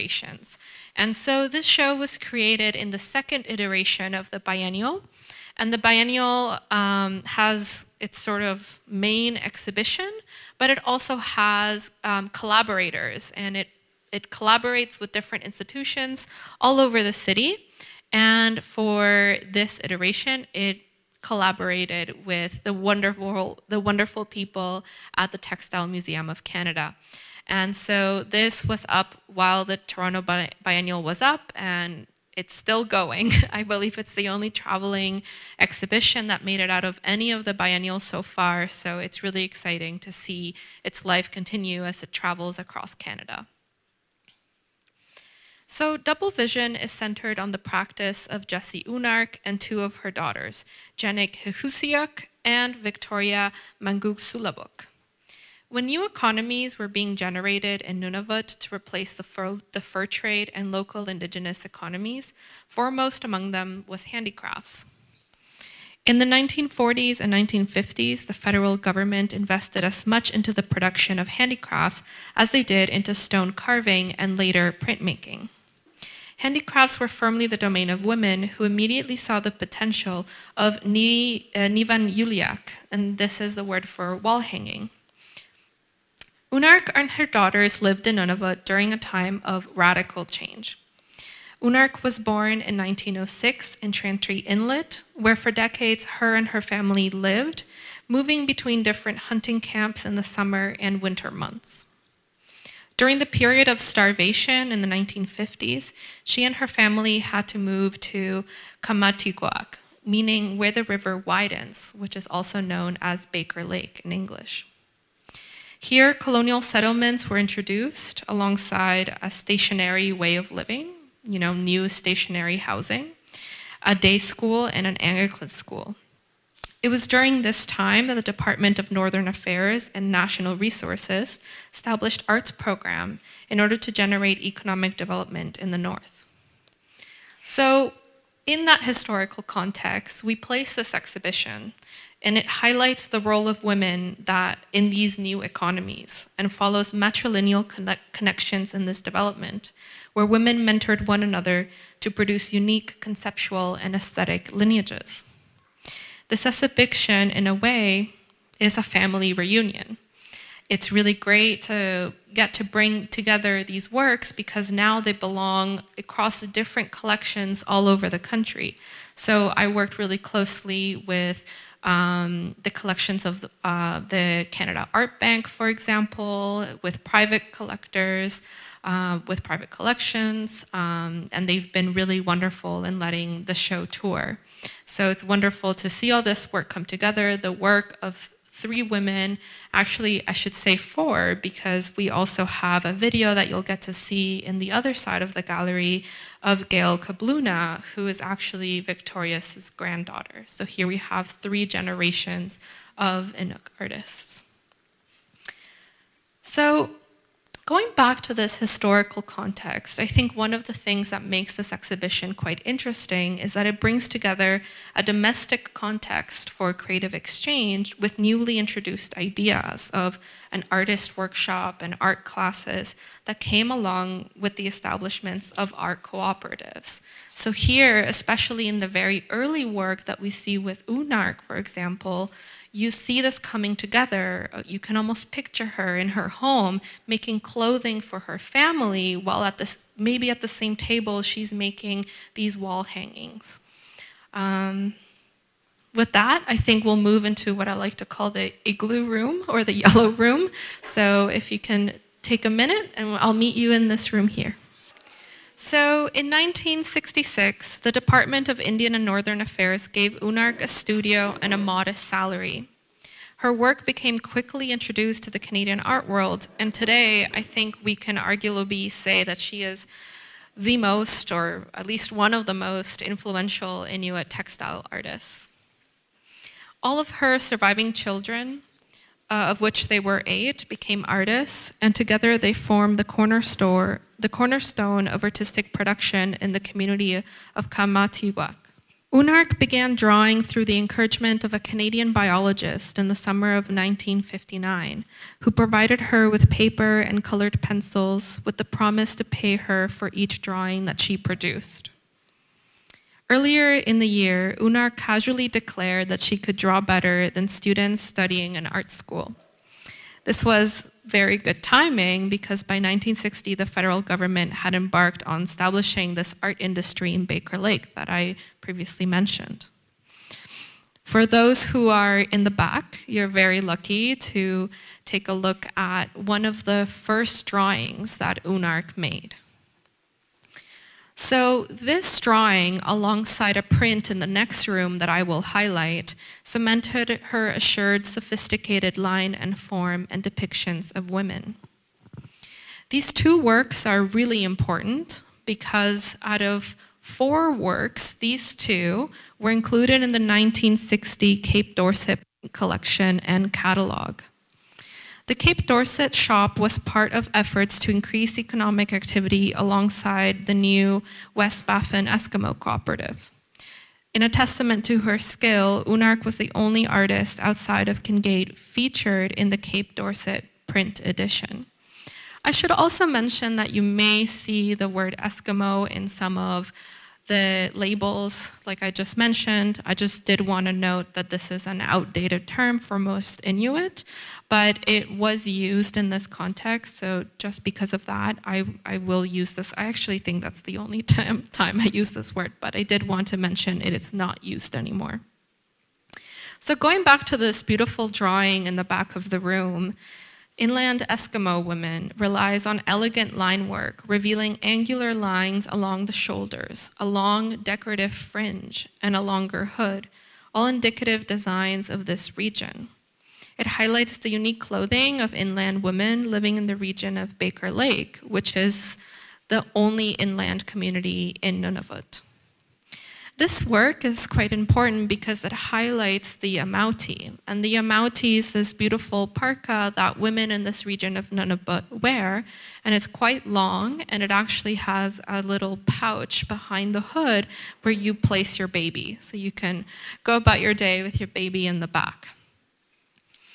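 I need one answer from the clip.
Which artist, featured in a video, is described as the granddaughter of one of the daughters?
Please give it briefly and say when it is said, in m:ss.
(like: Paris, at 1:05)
Gayle Kabloona, at 3:16.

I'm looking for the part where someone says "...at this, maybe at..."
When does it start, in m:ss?
3:59.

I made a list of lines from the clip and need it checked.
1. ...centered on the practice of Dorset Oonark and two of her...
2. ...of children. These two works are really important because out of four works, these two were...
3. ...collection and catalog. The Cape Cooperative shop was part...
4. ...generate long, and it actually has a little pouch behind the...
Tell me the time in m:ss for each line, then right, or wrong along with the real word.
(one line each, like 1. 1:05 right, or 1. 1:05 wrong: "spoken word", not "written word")
1. 0:46 wrong: "Jessie", not "Dorset"
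2. 5:40 wrong: "women", not "children"
3. 5:52 wrong: "Dorset", not "Cooperative"
4. 7:13 wrong: "quite", not "generate".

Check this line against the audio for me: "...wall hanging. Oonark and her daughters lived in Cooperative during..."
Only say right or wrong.
wrong.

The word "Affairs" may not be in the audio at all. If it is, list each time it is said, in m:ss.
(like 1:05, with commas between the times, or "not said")
2:09, 4:19.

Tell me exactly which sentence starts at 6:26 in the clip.
So just because of that, I, I will use this.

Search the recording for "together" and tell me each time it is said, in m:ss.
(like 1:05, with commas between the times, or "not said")
2:43, 3:06, 3:34, 3:53, 4:41.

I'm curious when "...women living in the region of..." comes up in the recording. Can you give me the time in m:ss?
6:55.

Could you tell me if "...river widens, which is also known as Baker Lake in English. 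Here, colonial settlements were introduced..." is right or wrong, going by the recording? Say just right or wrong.
right.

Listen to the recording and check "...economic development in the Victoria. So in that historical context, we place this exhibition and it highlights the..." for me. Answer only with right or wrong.
wrong.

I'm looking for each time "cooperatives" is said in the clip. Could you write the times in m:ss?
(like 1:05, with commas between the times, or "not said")
3:46, 6:02.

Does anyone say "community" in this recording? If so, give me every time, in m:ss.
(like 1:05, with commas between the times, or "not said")
4:46, 7:00.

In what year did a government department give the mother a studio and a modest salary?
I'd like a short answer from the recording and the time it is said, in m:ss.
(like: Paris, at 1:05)
1966, at 4:16.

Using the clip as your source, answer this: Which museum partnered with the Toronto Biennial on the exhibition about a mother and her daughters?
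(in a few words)
Textile Museum of Canada.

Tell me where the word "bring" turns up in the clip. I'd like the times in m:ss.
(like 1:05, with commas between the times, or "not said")
2:42, 3:33.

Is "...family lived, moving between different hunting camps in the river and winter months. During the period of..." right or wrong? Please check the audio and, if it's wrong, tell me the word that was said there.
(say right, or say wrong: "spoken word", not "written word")
wrong: "summer", not "river".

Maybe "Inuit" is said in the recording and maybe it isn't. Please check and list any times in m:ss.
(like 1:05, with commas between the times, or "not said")
4:33, 6:23.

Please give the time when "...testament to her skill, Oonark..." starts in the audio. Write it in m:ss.
6:04.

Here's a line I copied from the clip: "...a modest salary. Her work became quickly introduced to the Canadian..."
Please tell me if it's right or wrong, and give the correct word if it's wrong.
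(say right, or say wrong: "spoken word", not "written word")
right.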